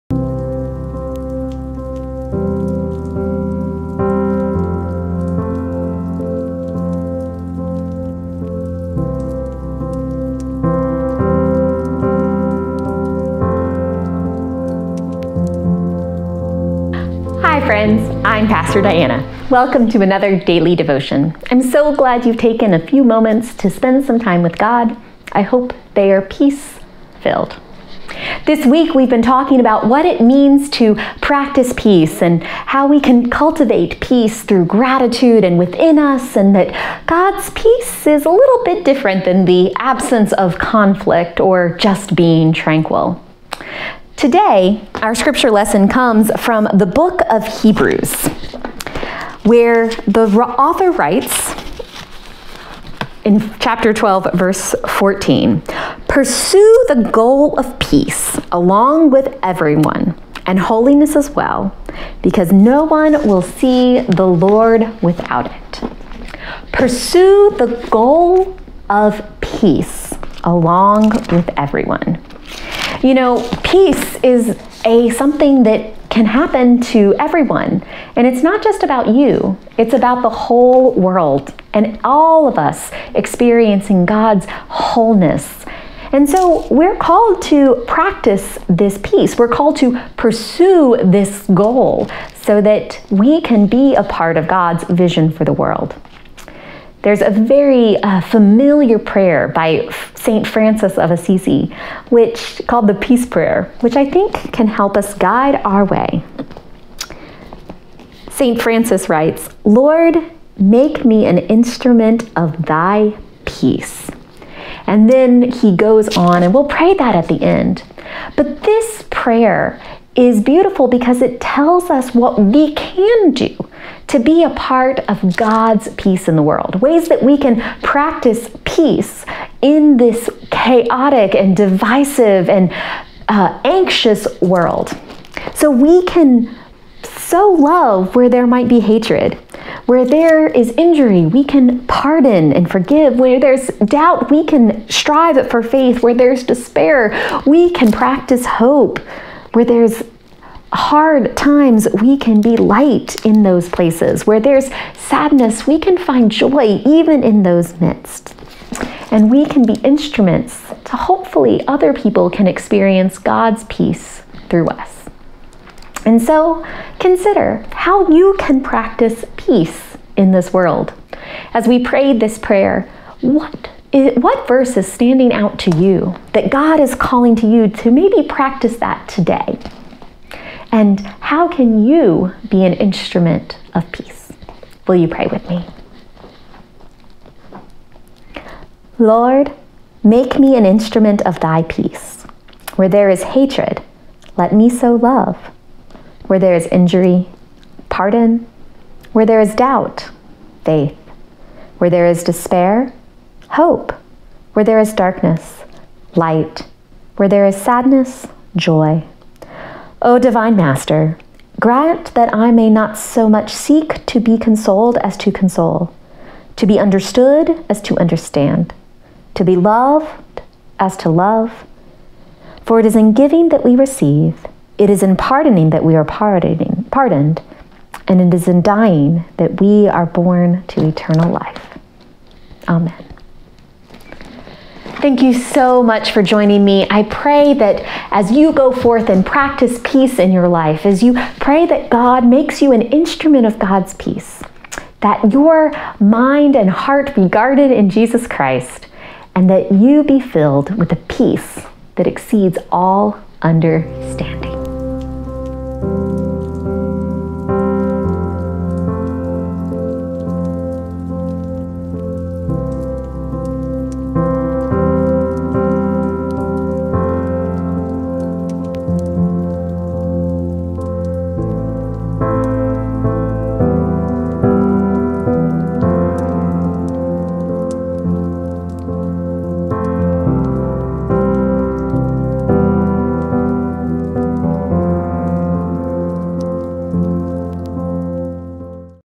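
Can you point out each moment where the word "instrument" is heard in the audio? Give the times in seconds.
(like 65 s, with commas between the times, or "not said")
111 s, 159 s, 182 s, 190 s, 242 s.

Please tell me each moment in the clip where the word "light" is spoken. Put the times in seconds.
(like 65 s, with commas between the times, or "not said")
152 s, 206 s.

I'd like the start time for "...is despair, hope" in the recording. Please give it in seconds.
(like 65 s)
202 s.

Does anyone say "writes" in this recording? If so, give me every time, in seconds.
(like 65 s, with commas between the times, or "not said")
50 s, 109 s.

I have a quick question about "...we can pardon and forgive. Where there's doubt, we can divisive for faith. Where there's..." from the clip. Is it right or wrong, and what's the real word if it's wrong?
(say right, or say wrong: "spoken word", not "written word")
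wrong: "strive", not "divisive".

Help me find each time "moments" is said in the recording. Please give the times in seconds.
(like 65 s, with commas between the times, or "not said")
23 s.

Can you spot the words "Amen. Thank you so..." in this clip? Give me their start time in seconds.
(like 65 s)
232 s.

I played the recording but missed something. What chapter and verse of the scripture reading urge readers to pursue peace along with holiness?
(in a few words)
chapter 12, verse 14.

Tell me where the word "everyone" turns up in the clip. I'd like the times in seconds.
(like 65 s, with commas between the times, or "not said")
59 s, 71 s, 77 s.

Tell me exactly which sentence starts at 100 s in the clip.
Francis of Assisi, which called the Peace Prayer, which I think can help us guide our way.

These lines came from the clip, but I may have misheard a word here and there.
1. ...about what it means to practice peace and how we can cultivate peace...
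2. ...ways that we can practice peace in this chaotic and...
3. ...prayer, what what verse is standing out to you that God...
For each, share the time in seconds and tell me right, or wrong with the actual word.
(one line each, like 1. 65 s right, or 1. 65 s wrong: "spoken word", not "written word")
1. 29 s right
2. 126 s right
3. 172 s right.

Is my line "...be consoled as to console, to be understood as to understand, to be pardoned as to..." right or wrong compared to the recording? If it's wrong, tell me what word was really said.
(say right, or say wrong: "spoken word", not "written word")
wrong: "loved", not "pardoned".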